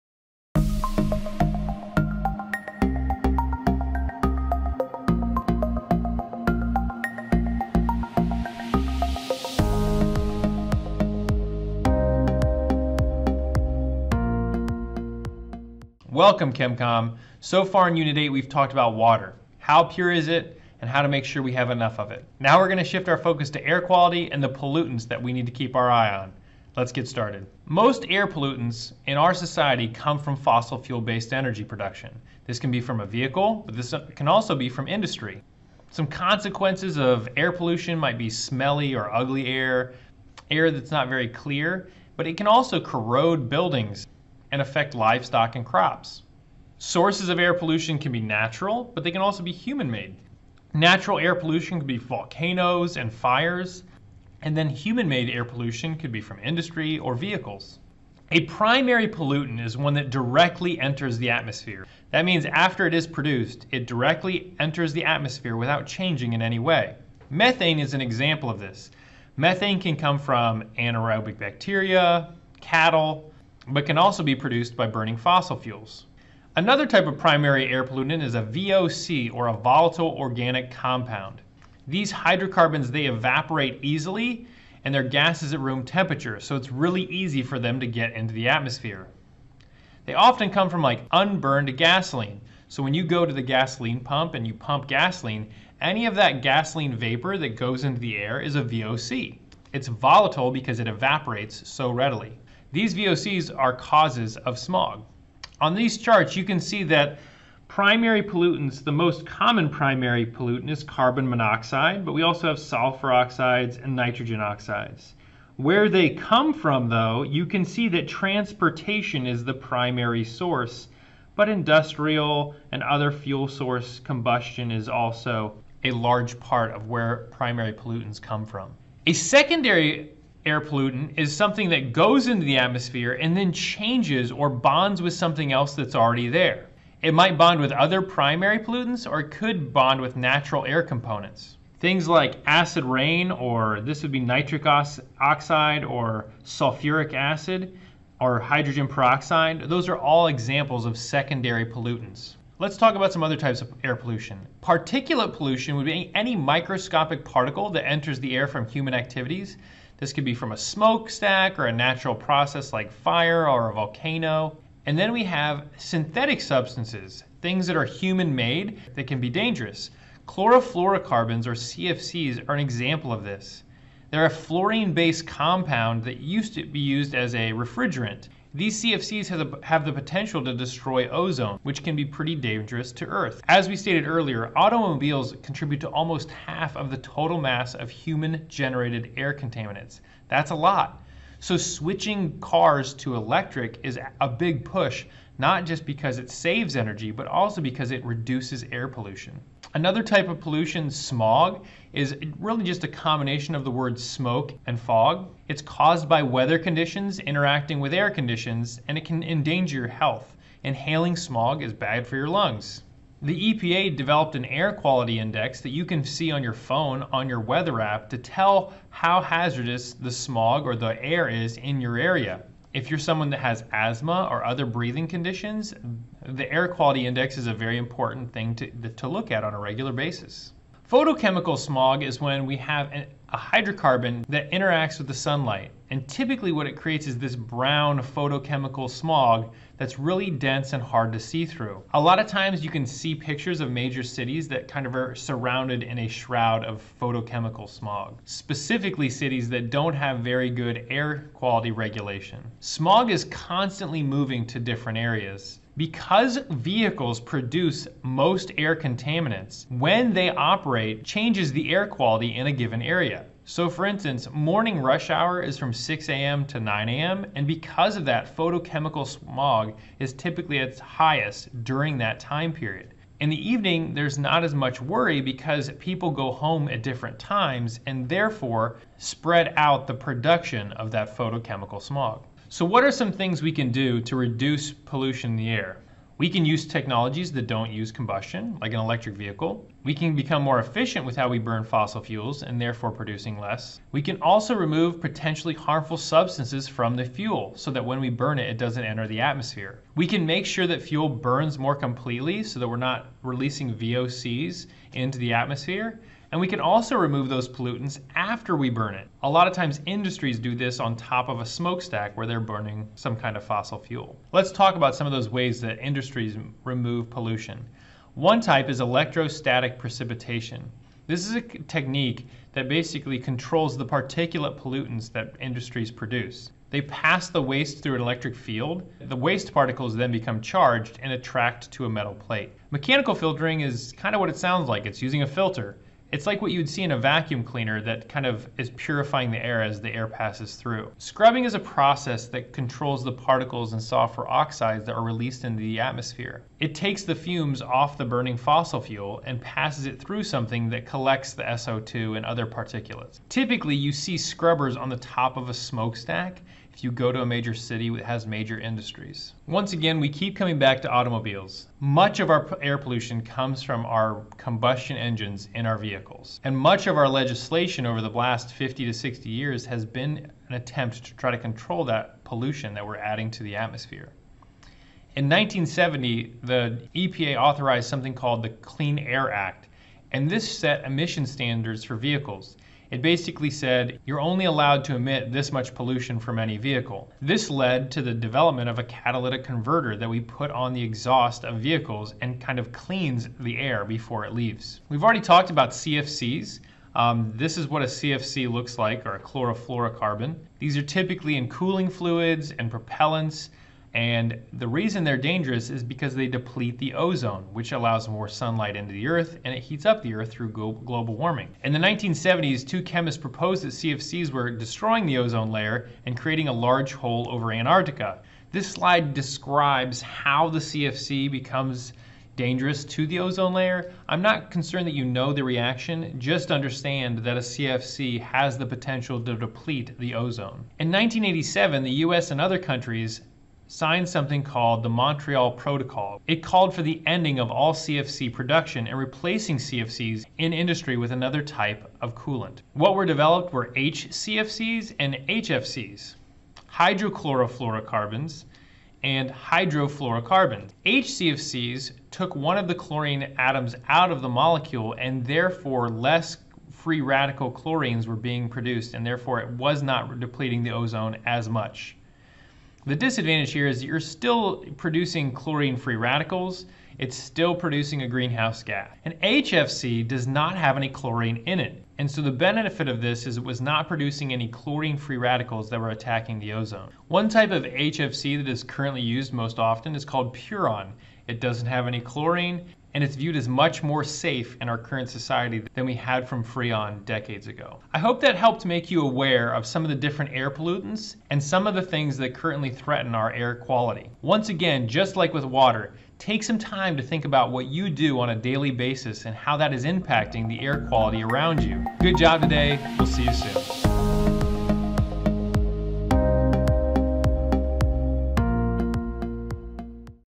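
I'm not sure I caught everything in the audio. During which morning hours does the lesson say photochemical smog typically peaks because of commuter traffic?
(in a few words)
6 a.m. to 9 a.m.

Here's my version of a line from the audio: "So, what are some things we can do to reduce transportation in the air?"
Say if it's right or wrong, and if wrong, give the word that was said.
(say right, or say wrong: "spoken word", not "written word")
wrong: "pollution", not "transportation".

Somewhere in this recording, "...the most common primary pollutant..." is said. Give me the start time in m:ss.
1:48.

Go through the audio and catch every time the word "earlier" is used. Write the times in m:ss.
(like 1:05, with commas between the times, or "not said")
3:04.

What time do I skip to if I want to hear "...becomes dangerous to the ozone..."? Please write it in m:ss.
7:01.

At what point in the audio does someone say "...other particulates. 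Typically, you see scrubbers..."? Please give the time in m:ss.
5:52.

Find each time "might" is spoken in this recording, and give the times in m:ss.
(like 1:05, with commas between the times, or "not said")
0:37, 2:17.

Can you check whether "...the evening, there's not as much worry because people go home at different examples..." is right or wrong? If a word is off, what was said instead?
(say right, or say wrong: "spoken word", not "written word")
wrong: "times", not "examples".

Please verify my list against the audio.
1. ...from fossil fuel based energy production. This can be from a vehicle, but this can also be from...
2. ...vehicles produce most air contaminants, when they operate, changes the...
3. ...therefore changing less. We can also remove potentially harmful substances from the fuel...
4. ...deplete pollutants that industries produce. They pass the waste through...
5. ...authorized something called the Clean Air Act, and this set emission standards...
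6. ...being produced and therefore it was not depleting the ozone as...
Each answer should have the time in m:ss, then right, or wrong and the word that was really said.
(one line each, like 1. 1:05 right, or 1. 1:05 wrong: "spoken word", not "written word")
1. 0:30 right
2. 4:16 right
3. 4:52 wrong: "producing", not "changing"
4. 5:23 wrong: "particulate", not "deplete"
5. 6:17 right
6. 7:38 right.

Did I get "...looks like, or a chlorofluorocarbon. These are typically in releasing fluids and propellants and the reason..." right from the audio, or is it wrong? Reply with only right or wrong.
wrong.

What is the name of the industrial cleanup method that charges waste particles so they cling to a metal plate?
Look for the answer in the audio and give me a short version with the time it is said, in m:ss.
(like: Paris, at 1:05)
Electrostatic precipitation, at 5:18.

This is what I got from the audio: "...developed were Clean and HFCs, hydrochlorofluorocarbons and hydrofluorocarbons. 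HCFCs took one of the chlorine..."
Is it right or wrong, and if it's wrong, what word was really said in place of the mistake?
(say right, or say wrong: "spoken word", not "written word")
wrong: "HCFCs", not "Clean".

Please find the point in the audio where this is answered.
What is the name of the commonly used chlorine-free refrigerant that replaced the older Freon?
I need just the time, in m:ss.
8:00.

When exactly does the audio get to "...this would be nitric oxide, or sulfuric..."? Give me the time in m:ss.
2:23.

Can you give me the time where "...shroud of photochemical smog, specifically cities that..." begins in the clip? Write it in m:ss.
4:06.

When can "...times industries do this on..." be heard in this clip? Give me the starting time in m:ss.
5:09.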